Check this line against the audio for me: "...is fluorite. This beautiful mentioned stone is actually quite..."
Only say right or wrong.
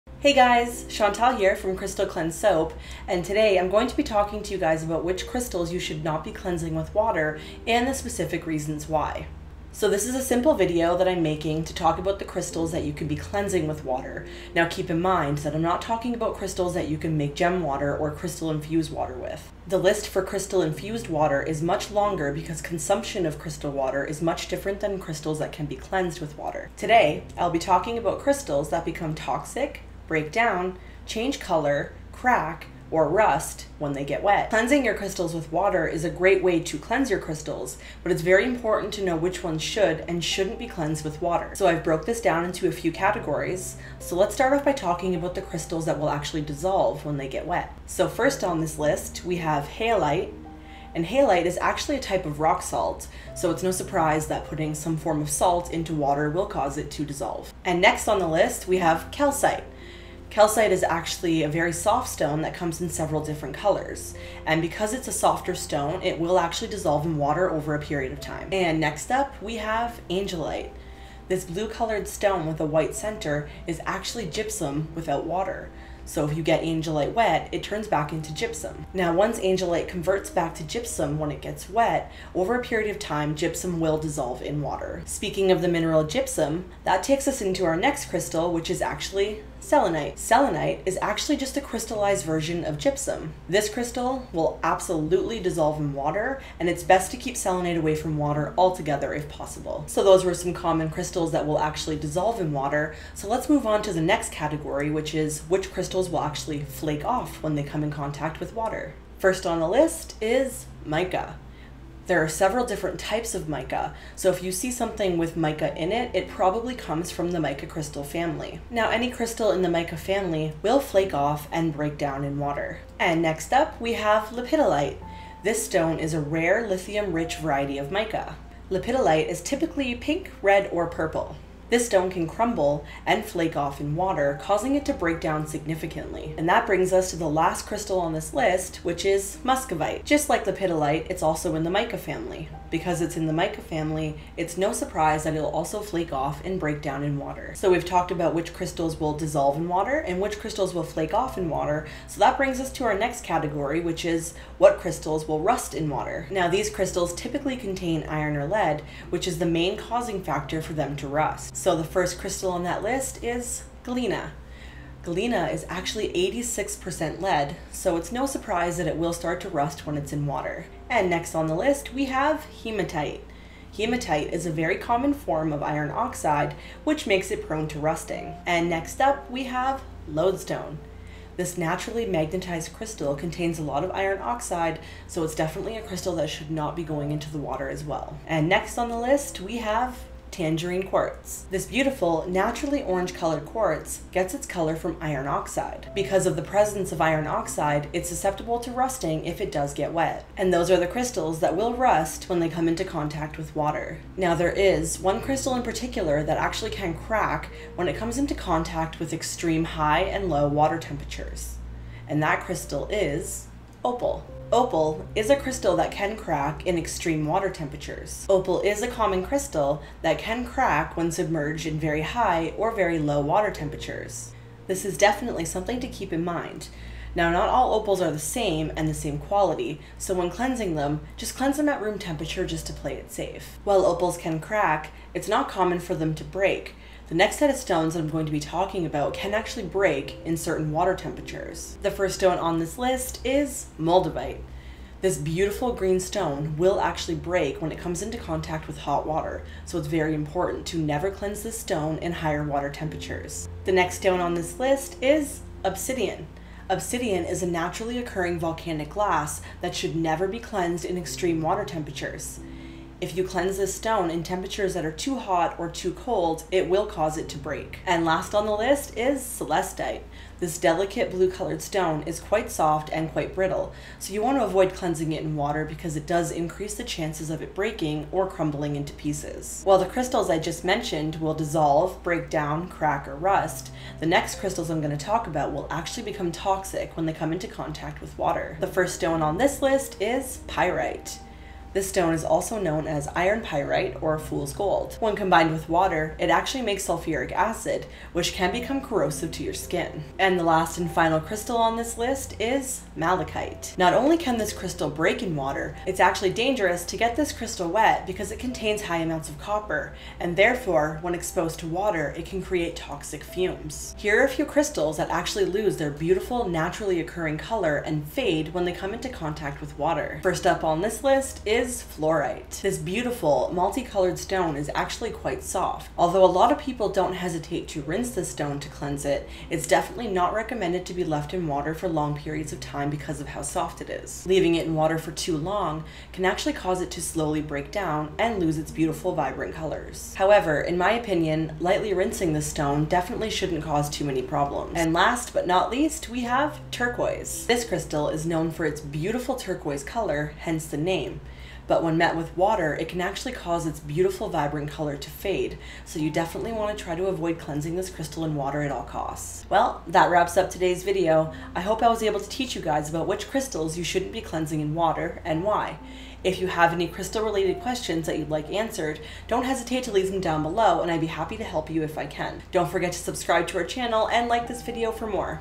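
wrong.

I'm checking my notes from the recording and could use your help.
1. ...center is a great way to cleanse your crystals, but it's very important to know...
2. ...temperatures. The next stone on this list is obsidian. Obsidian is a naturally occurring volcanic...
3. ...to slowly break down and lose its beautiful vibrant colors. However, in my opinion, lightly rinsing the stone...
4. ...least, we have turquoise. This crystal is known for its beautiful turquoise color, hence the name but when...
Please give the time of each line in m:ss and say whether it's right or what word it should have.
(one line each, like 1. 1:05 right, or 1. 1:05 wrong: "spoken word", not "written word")
1. 0:35 wrong: "water", not "center"
2. 4:12 right
3. 5:36 right
4. 5:45 right.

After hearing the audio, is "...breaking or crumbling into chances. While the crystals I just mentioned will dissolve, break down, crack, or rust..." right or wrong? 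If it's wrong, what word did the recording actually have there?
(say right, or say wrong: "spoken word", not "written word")
wrong: "pieces", not "chances".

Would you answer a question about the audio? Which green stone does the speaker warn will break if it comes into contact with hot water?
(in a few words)
moldavite.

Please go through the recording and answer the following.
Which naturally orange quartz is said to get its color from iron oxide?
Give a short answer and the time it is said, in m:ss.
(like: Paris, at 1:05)
tangerine quartz, at 3:10.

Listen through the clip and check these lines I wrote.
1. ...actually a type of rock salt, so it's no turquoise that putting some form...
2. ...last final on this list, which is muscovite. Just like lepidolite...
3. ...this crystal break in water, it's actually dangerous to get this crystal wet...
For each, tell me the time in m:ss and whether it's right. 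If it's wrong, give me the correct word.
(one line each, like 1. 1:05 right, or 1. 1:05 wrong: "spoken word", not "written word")
1. 0:51 wrong: "surprise", not "turquoise"
2. 2:17 wrong: "crystal", not "final"
3. 5:04 right.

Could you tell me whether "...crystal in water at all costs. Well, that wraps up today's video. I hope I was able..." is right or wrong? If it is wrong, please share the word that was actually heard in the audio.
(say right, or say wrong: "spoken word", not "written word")
right.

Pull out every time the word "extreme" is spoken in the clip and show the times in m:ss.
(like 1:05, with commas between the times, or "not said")
3:29, 3:36, 4:20.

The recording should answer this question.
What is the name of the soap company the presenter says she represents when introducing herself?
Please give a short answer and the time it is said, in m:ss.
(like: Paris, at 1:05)
Crystal Cleanse Soap, at 0:01.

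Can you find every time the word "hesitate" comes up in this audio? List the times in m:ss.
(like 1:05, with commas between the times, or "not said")
5:27, 6:09.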